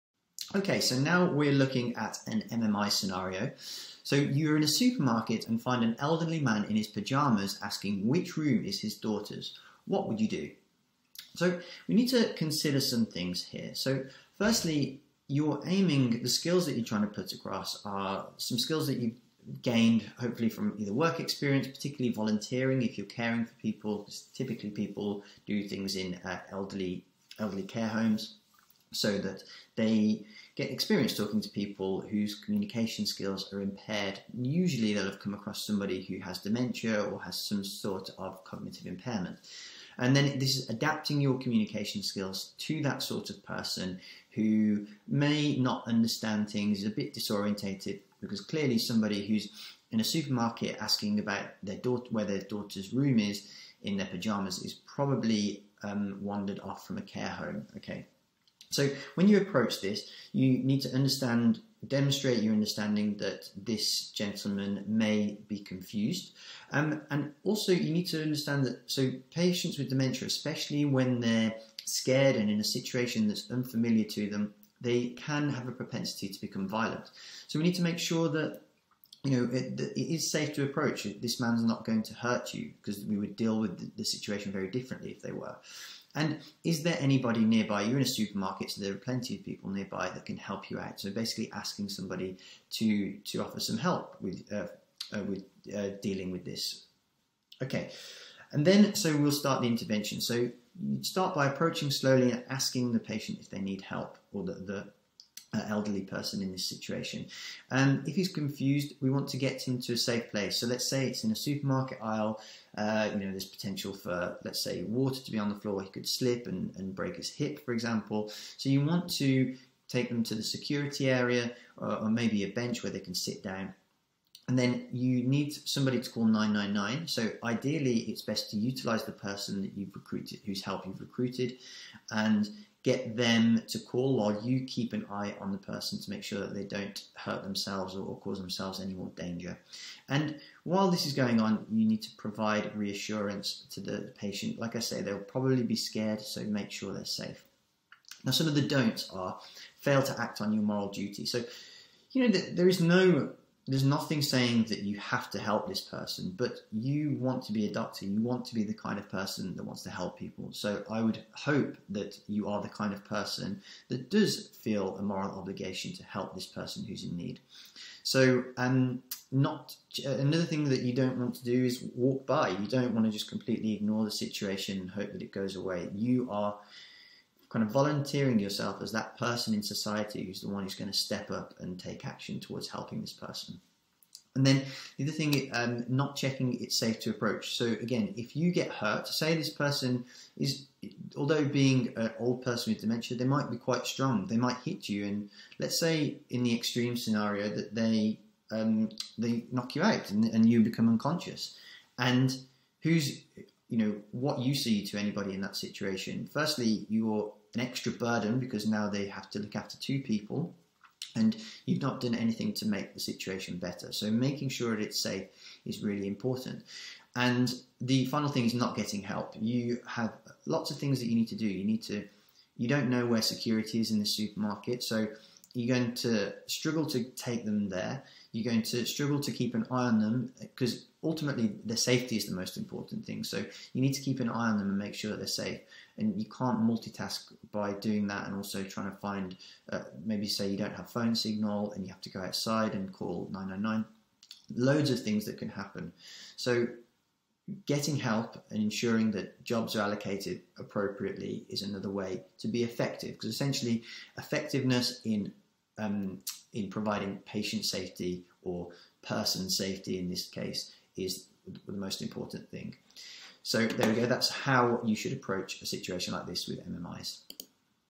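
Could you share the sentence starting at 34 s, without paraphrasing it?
Usually they'll have come across somebody who has dementia or has some sort of cognitive impairment.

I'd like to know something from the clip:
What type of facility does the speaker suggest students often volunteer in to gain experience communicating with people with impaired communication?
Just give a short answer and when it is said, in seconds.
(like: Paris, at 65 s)
Elderly care homes, at 27 s.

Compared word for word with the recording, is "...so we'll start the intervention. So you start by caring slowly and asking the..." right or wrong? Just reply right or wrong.
wrong.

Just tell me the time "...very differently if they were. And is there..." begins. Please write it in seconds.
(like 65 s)
84 s.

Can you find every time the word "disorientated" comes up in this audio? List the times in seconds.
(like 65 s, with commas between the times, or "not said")
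47 s.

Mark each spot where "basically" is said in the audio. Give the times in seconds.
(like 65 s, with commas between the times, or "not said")
91 s.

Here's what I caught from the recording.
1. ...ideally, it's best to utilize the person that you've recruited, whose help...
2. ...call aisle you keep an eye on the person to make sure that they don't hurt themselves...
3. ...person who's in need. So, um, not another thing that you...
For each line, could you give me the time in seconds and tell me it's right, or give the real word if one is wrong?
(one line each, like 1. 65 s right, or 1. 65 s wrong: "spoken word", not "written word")
1. 127 s right
2. 133 s wrong: "while", not "aisle"
3. 166 s right.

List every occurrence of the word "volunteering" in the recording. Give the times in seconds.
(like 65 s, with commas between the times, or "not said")
22 s, 177 s.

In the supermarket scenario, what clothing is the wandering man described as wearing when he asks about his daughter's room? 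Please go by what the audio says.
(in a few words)
Pyjamas.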